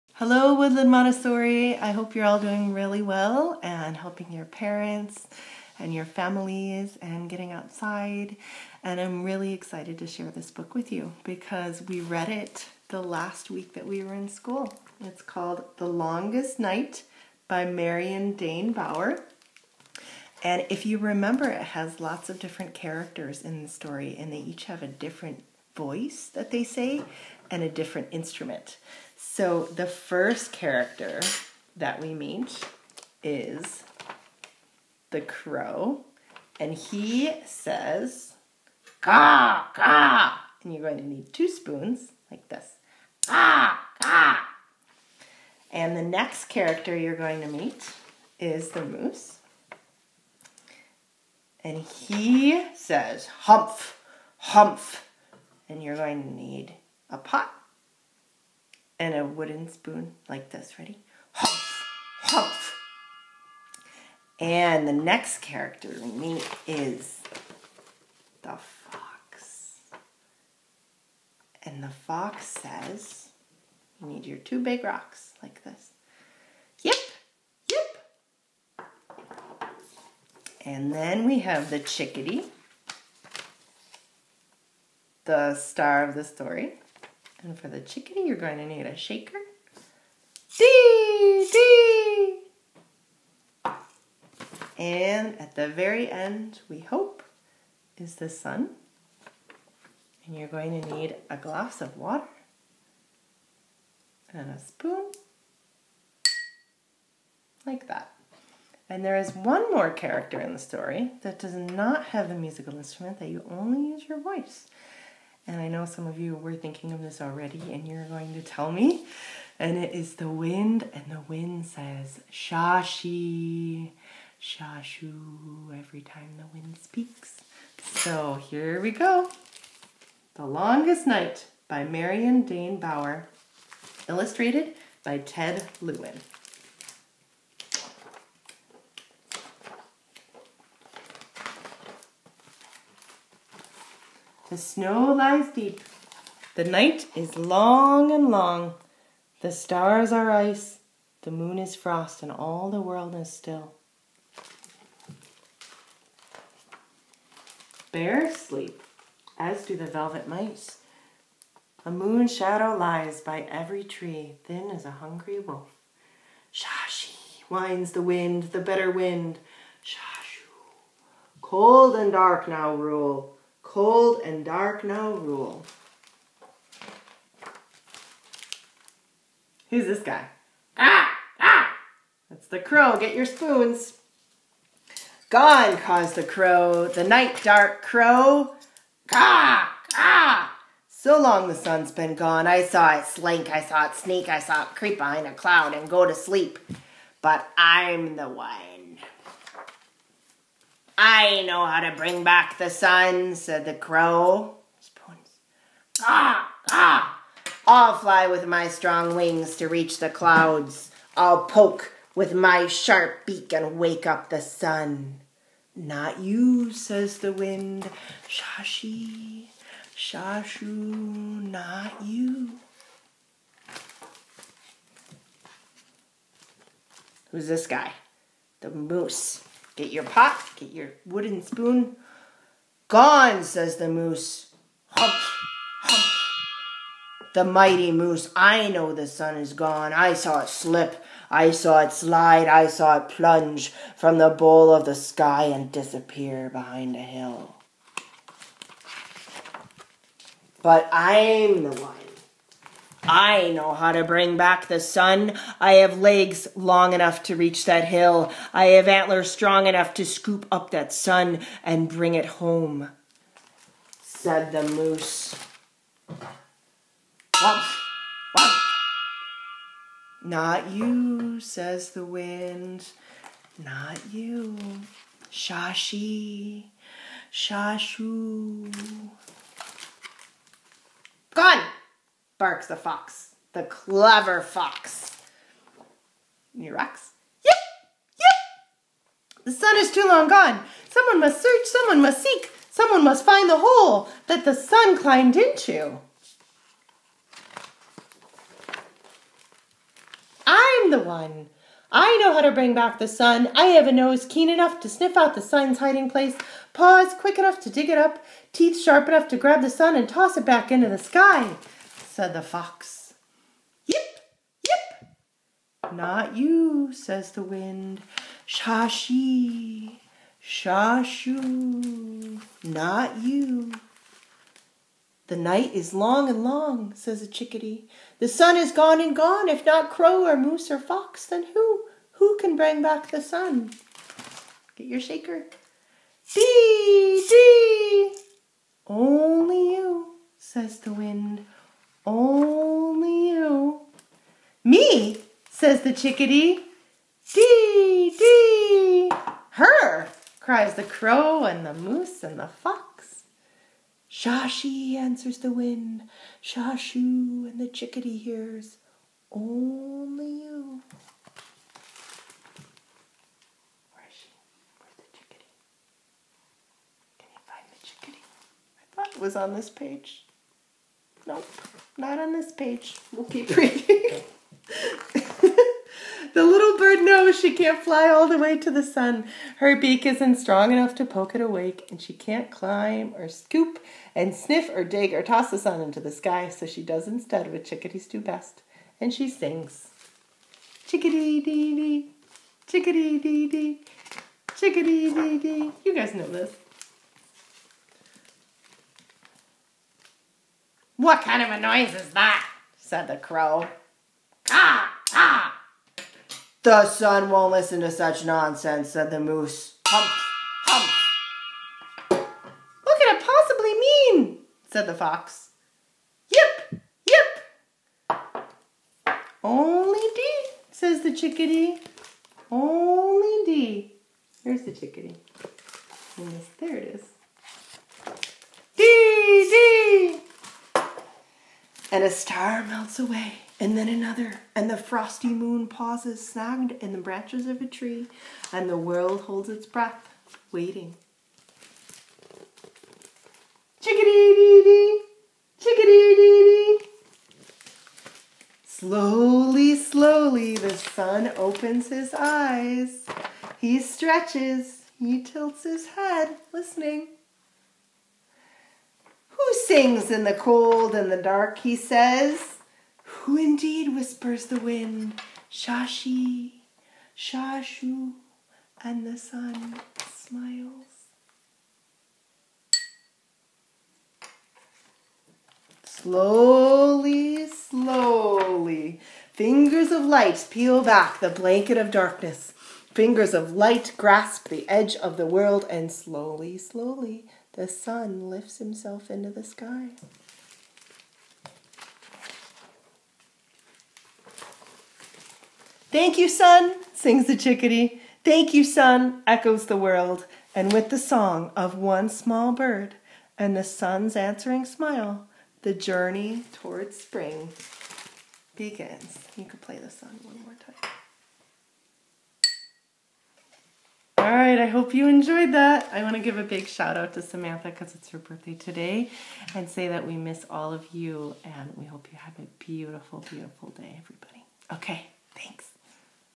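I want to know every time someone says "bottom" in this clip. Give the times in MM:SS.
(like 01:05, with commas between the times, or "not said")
not said.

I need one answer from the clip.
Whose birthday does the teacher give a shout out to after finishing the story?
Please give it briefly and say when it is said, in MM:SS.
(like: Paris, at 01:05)
Samantha, at 08:37.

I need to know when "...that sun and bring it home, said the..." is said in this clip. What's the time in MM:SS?
04:20.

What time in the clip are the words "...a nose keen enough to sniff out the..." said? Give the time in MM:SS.
05:03.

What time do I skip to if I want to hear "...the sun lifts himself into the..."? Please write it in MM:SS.
08:07.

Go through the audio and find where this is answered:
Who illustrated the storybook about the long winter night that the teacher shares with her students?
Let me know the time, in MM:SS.
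02:15.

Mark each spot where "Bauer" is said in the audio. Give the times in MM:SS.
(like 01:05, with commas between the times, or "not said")
00:18, 02:12.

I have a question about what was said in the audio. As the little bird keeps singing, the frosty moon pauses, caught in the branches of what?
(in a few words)
a tree.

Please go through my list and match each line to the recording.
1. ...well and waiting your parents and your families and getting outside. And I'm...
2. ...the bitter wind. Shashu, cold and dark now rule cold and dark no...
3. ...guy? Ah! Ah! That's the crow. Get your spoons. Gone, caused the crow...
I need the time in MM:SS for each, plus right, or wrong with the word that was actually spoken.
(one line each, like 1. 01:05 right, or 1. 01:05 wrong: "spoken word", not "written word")
1. 00:03 wrong: "helping", not "waiting"
2. 02:48 right
3. 03:00 right.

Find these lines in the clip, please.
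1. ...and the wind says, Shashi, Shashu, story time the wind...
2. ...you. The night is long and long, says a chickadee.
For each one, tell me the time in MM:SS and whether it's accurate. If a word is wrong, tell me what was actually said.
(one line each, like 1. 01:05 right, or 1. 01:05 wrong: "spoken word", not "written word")
1. 02:00 wrong: "every", not "story"
2. 05:23 right.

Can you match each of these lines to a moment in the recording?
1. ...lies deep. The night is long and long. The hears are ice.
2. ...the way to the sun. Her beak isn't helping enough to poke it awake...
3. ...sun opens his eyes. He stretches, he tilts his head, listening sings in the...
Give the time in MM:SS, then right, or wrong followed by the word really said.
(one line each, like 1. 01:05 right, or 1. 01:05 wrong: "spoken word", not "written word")
1. 02:25 wrong: "stars", not "hears"
2. 06:18 wrong: "strong", not "helping"
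3. 07:30 right.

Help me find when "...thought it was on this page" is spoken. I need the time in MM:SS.
06:08.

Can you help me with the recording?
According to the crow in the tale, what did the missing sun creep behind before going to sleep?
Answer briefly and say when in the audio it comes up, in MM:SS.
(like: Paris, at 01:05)
a cloud, at 03:15.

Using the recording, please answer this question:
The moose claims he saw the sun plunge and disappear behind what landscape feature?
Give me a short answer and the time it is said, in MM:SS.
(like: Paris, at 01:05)
a hill, at 04:06.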